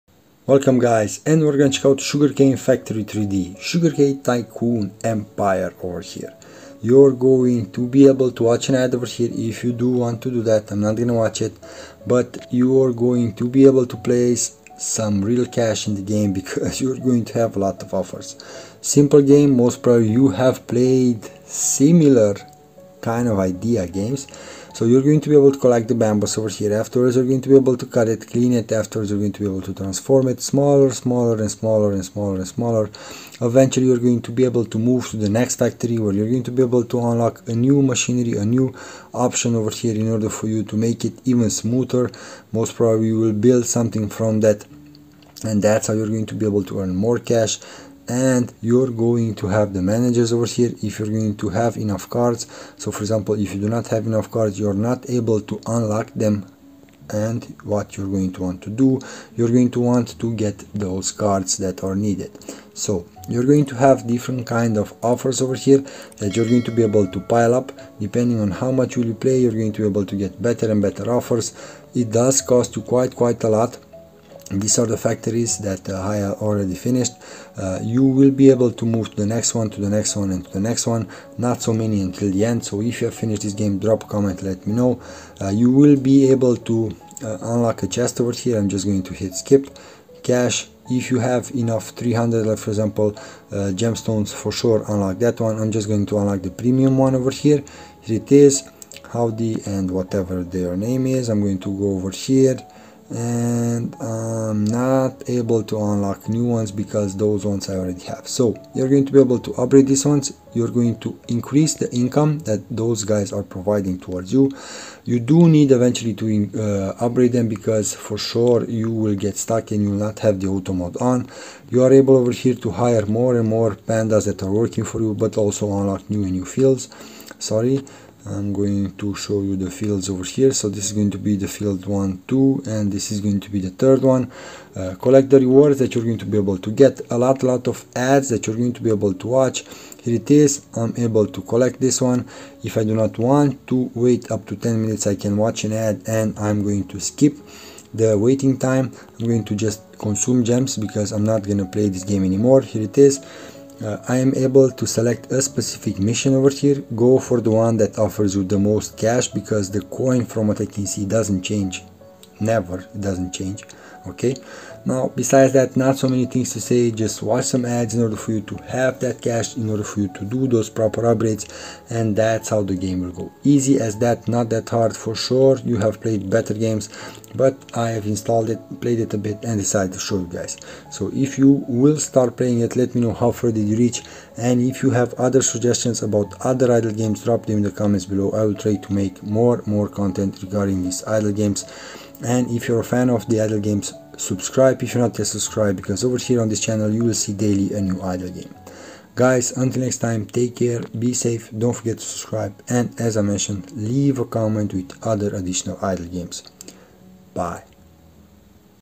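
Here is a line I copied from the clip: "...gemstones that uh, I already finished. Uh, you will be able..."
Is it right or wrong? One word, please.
wrong.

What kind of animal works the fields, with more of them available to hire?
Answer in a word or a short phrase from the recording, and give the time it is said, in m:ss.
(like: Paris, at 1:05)
pandas, at 2:03.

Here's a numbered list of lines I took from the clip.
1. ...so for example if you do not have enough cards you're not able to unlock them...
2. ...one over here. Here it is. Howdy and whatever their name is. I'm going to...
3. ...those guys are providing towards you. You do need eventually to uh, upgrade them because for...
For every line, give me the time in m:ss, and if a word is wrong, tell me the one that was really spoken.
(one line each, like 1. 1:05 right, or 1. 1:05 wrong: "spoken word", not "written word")
1. 0:52 right
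2. 1:36 right
3. 1:52 right.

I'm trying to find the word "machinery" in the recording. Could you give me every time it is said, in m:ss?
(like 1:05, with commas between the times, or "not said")
0:37.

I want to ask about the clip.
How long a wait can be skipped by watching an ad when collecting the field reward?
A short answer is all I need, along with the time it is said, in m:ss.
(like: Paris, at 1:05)
10 minutes, at 2:24.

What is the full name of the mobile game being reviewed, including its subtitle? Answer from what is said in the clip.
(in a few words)
Sugarcane Factory 3D.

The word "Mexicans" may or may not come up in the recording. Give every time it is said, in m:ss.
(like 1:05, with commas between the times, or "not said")
not said.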